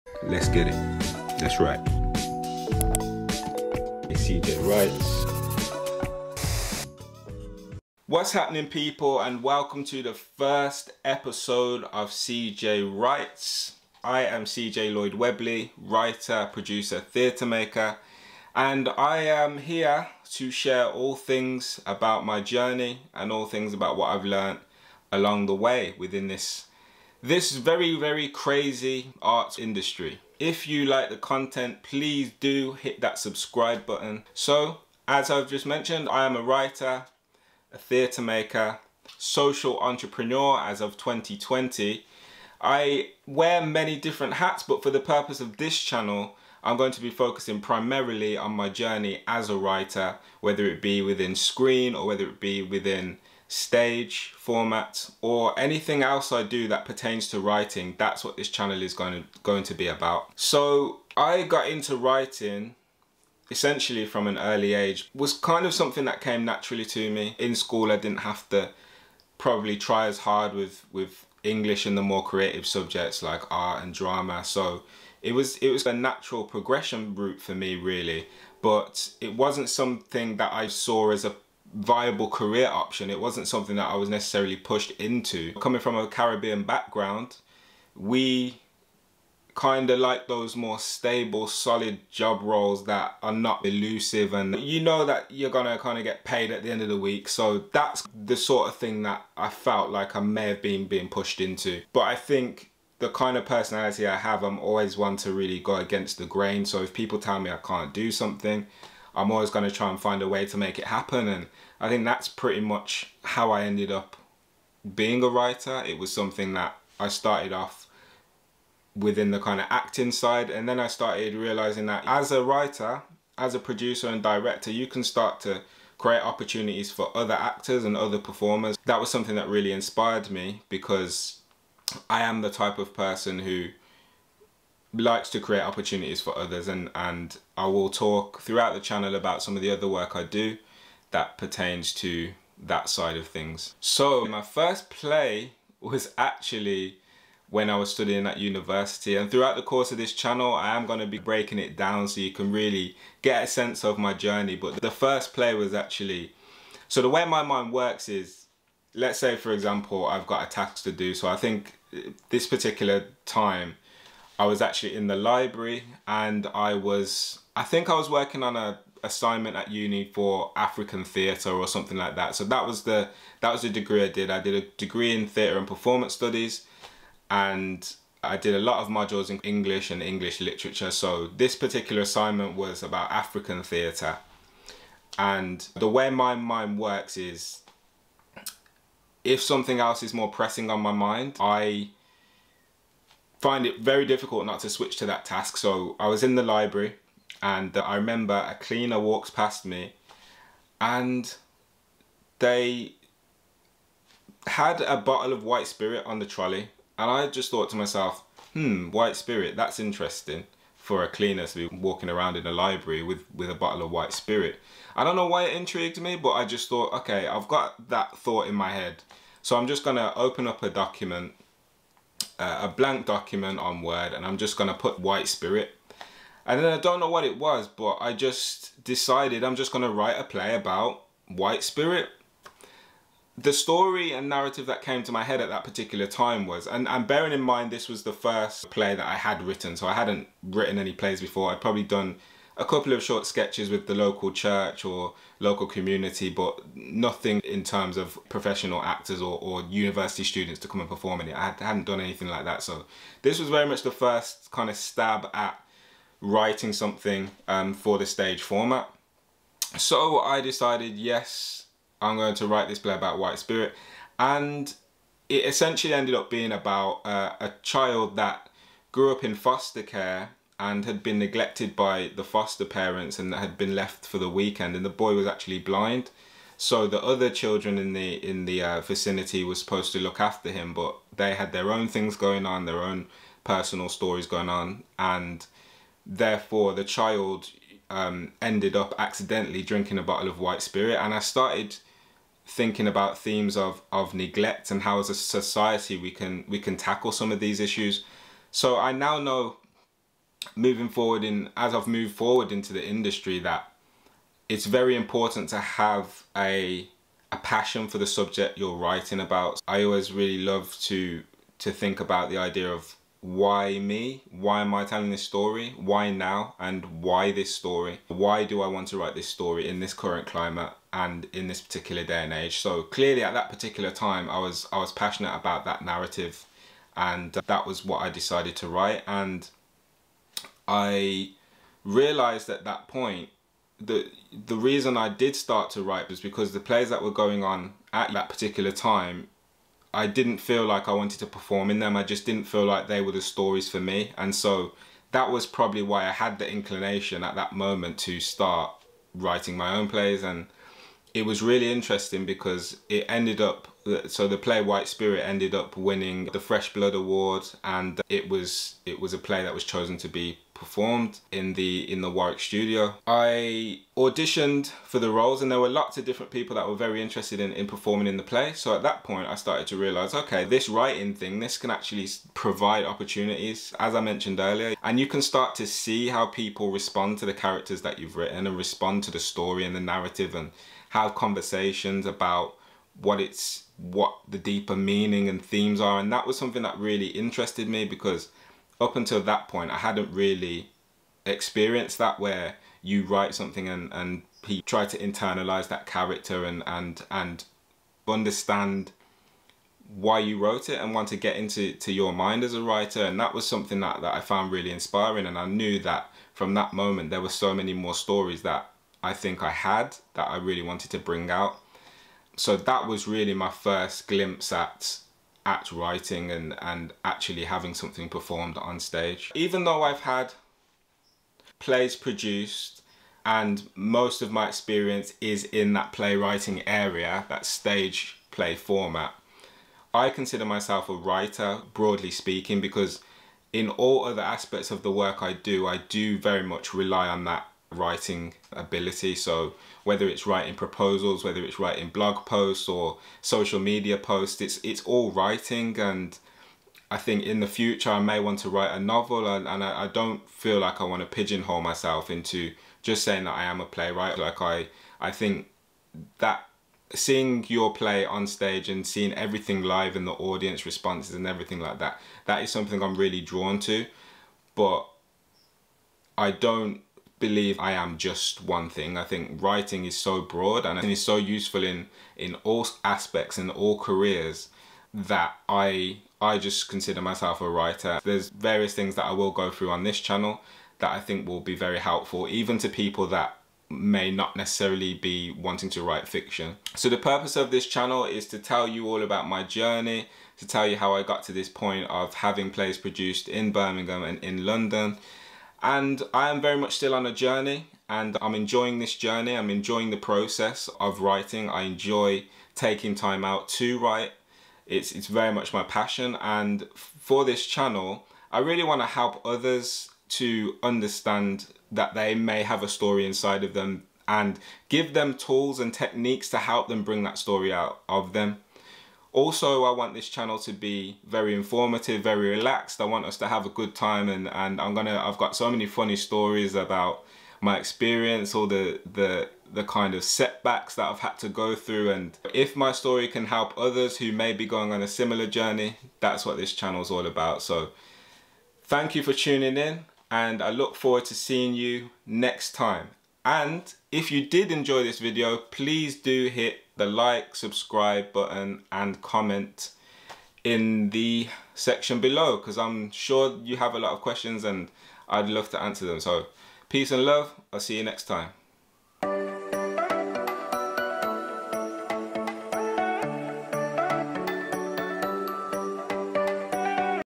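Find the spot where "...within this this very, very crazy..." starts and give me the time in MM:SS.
00:25.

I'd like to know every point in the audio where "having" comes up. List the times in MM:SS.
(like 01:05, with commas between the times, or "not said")
06:57, 08:12.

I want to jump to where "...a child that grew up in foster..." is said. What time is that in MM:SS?
04:27.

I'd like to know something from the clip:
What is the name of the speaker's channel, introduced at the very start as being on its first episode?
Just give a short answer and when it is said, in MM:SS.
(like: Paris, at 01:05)
CJ Writes, at 00:12.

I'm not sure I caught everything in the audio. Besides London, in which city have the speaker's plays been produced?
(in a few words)
Birmingham.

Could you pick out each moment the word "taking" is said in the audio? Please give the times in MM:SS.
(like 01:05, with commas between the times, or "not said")
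08:22.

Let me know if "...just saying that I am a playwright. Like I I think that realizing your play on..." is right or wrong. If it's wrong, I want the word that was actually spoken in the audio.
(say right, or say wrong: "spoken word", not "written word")
wrong: "seeing", not "realizing".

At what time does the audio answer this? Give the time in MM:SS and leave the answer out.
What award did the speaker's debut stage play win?
05:56.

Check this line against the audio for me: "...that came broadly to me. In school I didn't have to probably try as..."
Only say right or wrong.
wrong.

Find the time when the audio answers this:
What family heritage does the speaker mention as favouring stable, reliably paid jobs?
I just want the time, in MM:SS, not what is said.
01:26.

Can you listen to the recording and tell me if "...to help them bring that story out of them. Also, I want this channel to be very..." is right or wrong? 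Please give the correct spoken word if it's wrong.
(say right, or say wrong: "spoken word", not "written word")
right.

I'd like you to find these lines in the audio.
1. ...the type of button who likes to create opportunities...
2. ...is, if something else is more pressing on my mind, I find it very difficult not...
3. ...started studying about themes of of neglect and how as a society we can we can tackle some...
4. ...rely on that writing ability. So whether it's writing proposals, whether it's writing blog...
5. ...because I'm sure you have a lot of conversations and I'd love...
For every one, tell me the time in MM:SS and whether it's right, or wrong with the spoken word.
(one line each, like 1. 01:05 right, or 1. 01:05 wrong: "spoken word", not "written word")
1. 02:12 wrong: "person", not "button"
2. 03:07 right
3. 04:51 wrong: "thinking", not "studying"
4. 07:16 right
5. 09:12 wrong: "questions", not "conversations".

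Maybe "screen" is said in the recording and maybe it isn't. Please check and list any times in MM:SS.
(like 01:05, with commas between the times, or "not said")
00:51.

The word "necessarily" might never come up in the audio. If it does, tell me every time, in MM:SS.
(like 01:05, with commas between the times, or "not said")
01:24, 08:04.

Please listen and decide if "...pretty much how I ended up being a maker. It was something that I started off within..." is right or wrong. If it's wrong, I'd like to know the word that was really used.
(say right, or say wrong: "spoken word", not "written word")
wrong: "writer", not "maker".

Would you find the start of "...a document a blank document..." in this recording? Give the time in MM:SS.
03:40.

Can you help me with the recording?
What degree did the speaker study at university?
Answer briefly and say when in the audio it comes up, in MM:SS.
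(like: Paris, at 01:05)
Theatre and performance studies, at 02:55.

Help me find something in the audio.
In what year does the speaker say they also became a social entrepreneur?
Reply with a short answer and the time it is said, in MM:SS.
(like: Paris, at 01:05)
2020, at 00:40.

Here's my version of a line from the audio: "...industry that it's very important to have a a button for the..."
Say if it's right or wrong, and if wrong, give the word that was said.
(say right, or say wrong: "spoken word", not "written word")
wrong: "passion", not "button".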